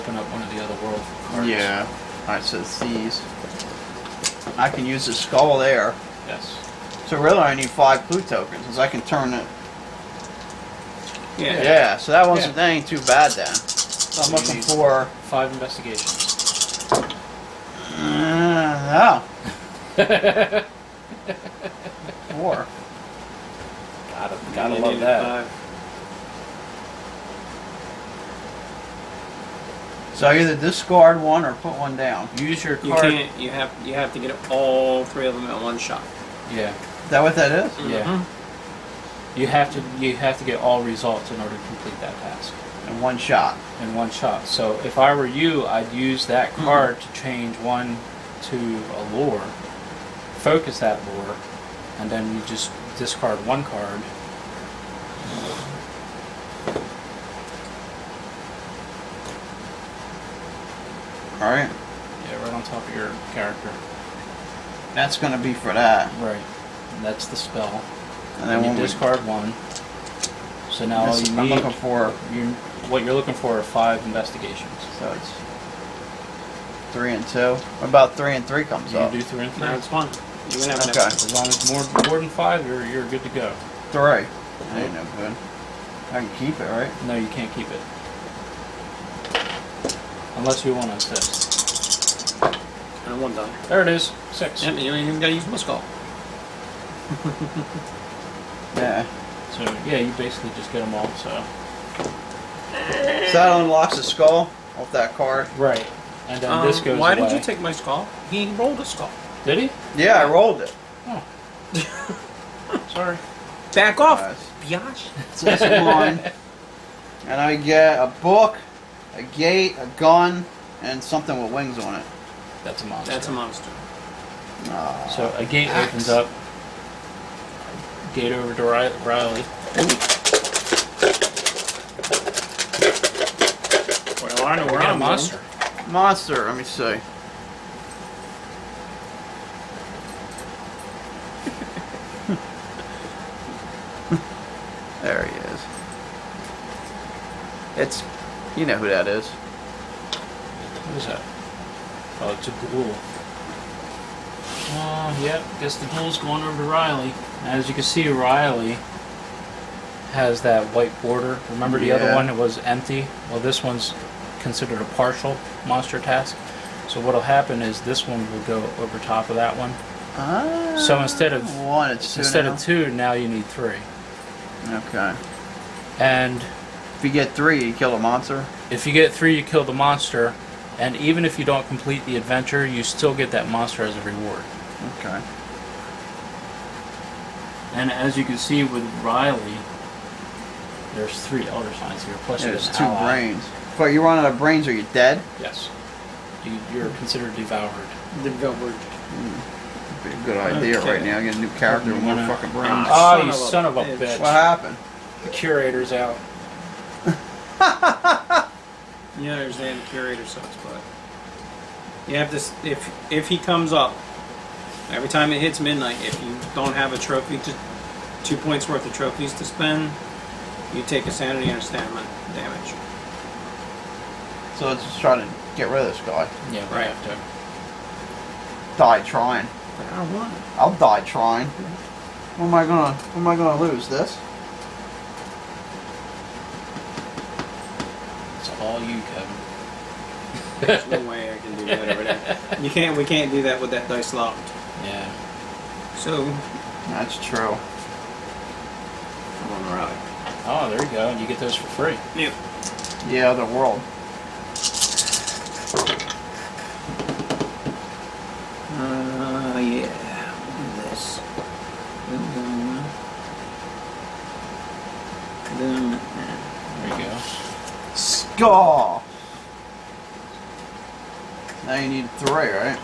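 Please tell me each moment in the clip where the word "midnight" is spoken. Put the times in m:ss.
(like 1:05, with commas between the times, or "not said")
3:35.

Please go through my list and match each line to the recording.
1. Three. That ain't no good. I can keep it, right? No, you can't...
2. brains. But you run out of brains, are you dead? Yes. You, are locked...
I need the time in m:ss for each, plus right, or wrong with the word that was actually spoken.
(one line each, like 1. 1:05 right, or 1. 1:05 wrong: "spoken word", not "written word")
1. 1:23 right
2. 3:13 wrong: "considered", not "locked".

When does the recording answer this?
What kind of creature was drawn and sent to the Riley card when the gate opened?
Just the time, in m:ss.
2:32.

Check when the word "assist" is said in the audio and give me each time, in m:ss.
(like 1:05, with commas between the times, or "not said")
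1:30.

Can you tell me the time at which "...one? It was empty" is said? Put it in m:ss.
2:42.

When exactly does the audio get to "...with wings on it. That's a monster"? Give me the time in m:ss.
2:01.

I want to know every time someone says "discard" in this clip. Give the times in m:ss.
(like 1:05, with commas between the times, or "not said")
0:30, 0:52, 1:08.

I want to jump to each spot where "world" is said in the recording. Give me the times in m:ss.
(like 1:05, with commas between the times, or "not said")
0:00, 4:13.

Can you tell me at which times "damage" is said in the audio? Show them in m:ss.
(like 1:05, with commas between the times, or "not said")
3:42.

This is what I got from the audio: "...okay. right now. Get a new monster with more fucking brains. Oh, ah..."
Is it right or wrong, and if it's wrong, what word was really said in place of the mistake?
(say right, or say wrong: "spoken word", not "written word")
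wrong: "character", not "monster".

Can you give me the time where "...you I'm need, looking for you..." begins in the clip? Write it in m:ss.
1:11.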